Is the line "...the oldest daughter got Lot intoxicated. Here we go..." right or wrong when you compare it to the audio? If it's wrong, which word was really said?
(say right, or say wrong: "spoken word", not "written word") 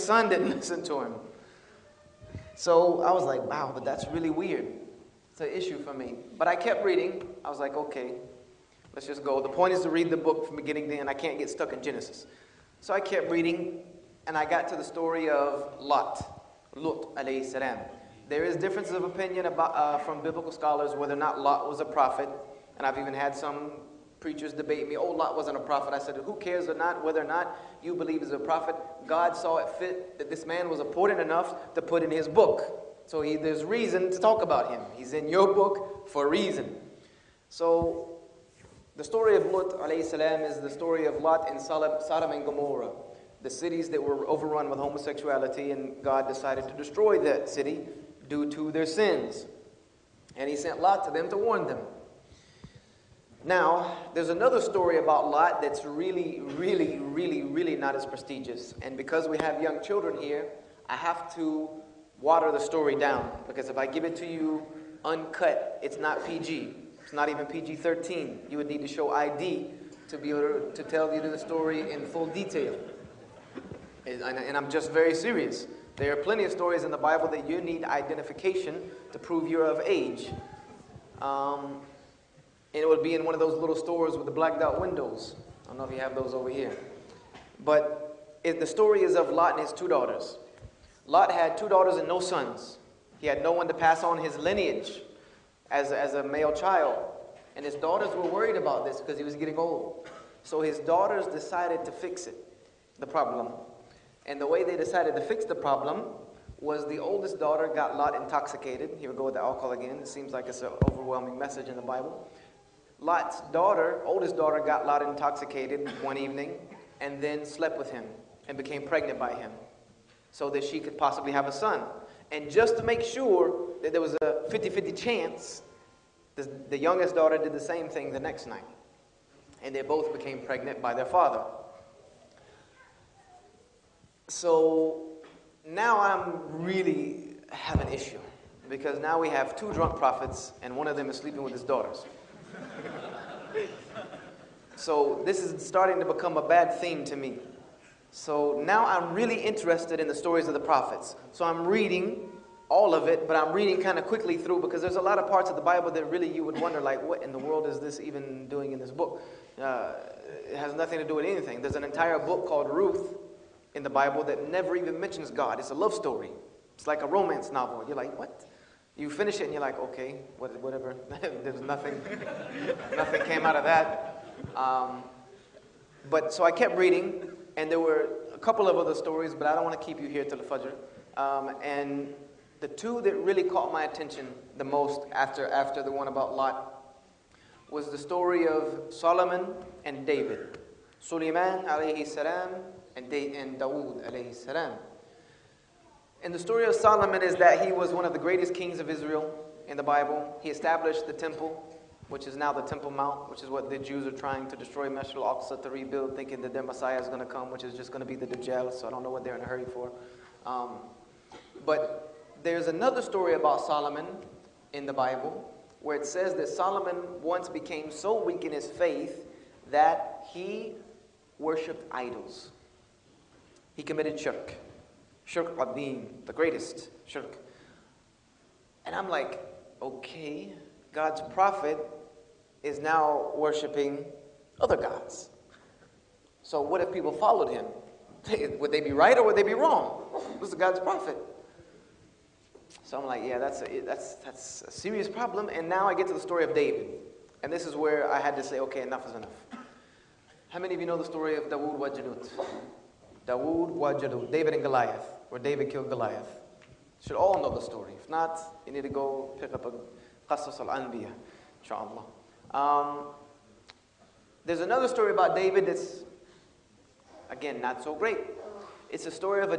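right.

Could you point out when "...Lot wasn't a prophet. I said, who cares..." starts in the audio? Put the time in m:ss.
0:25.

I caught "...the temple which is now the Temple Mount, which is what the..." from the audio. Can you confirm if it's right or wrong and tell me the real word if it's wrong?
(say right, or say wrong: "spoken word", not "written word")
right.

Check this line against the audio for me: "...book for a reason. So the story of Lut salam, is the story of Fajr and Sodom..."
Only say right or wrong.
wrong.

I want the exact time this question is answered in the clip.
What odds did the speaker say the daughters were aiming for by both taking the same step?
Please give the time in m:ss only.
2:04.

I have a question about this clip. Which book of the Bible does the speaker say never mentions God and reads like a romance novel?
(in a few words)
Ruth.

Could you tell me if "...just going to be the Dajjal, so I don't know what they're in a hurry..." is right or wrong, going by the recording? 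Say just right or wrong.
right.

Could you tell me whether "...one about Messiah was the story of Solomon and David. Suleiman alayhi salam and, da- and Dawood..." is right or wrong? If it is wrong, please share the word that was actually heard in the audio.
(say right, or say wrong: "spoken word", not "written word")
wrong: "Lot", not "Messiah".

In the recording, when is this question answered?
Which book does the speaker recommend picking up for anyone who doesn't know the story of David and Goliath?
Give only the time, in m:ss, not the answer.
4:20.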